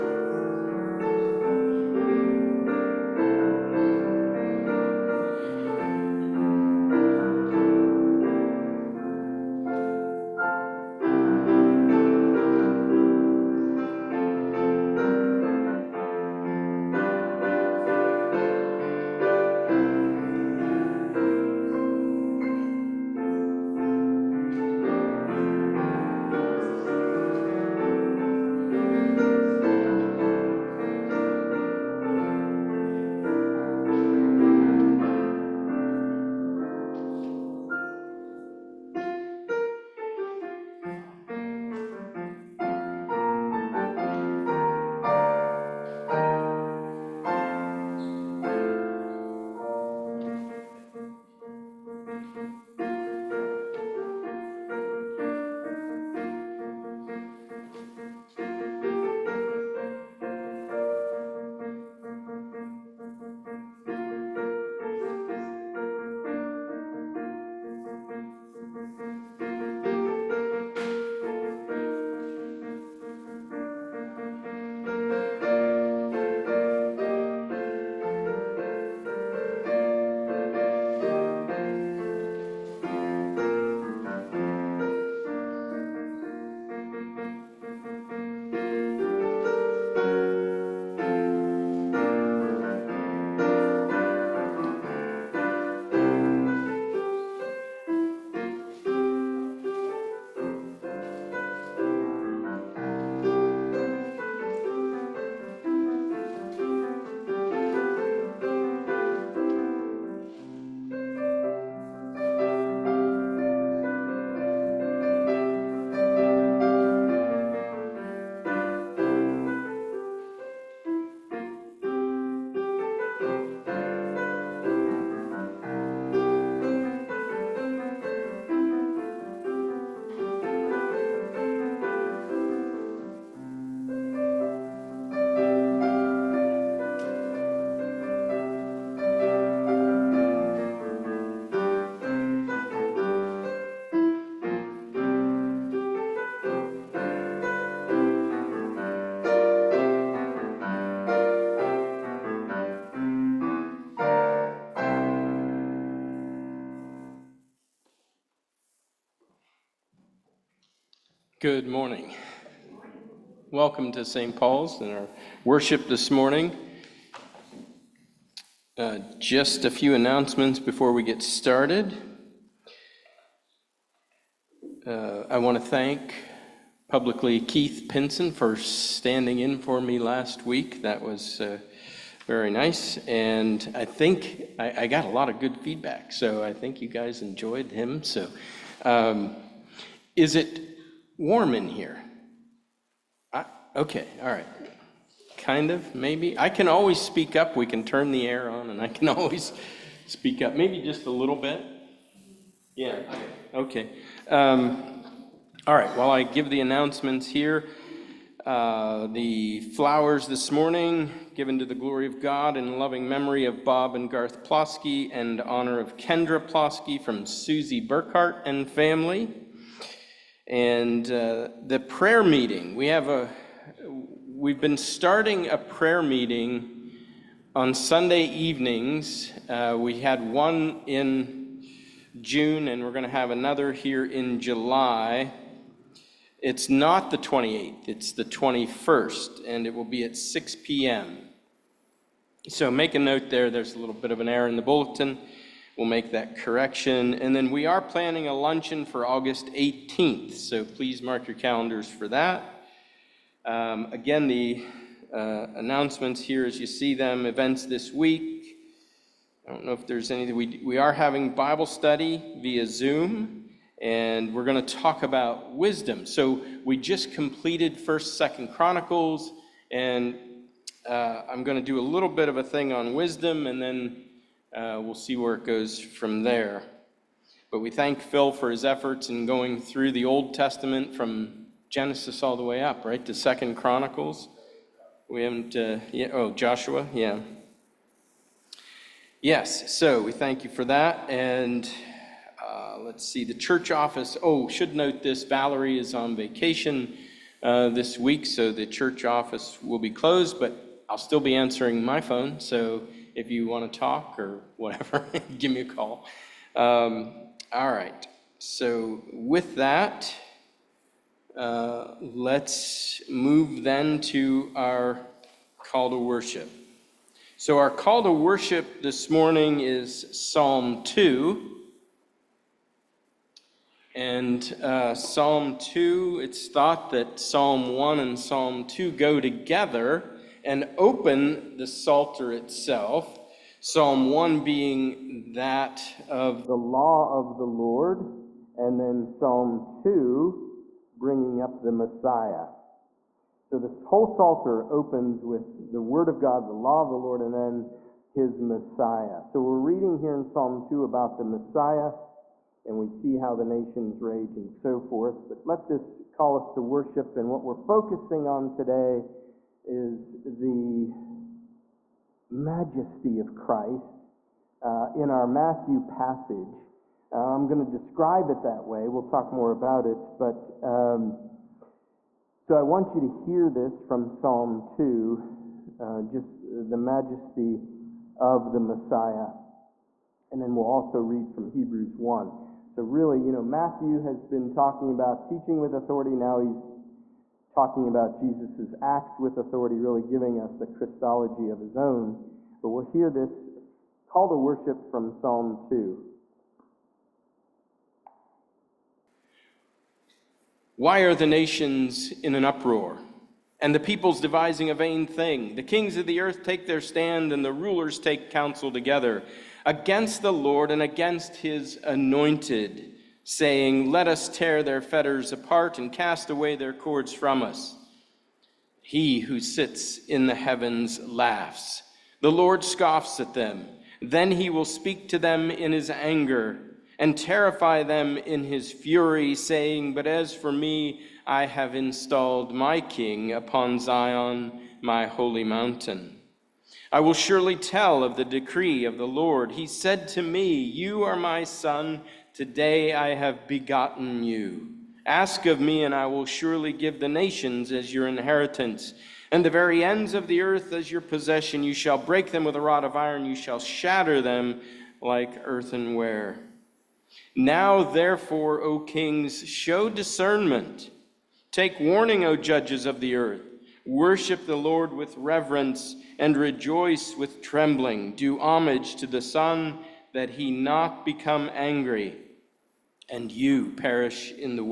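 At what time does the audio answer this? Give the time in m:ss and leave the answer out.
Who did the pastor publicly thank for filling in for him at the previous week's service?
2:57.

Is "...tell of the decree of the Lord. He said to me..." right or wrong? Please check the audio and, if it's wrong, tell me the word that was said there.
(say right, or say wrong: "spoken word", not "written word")
right.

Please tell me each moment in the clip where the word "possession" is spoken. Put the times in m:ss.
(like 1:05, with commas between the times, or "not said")
7:31.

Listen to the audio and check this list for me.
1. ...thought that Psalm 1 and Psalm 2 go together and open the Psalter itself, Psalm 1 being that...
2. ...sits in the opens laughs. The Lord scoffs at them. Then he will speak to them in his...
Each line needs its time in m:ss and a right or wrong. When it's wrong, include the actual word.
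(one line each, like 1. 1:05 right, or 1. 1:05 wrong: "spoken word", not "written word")
1. 5:26 right
2. 6:59 wrong: "heavens", not "opens".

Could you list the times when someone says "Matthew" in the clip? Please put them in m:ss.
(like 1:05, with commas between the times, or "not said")
6:05, 6:23.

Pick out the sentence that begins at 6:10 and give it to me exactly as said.
But um, so I want you to hear this from Psalm 2, uh, just the majesty of the Messiah.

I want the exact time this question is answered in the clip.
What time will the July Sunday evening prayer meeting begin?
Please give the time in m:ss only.
4:00.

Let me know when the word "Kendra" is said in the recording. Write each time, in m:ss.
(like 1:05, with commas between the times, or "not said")
3:35.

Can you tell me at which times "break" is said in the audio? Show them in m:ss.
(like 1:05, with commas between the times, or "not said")
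7:31.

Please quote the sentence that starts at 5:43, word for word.
So this whole Psalter opens with the Word of God, the law of the Lord, and then his Messiah.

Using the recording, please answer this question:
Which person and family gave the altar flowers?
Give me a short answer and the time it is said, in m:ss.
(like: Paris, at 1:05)
Susie Burkhart, at 3:37.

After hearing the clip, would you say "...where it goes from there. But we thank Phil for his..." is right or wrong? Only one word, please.
right.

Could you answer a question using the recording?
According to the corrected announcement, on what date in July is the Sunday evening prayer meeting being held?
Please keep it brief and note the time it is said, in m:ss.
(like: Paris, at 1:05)
21st, at 3:58.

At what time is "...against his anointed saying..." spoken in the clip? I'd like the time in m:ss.
6:50.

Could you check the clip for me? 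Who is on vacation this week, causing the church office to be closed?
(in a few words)
Valerie.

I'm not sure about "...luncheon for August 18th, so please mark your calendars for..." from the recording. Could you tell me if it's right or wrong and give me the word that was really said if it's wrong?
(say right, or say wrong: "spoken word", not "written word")
right.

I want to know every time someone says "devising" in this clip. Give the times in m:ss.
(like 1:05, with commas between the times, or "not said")
6:44.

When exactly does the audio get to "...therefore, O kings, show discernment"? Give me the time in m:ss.
7:37.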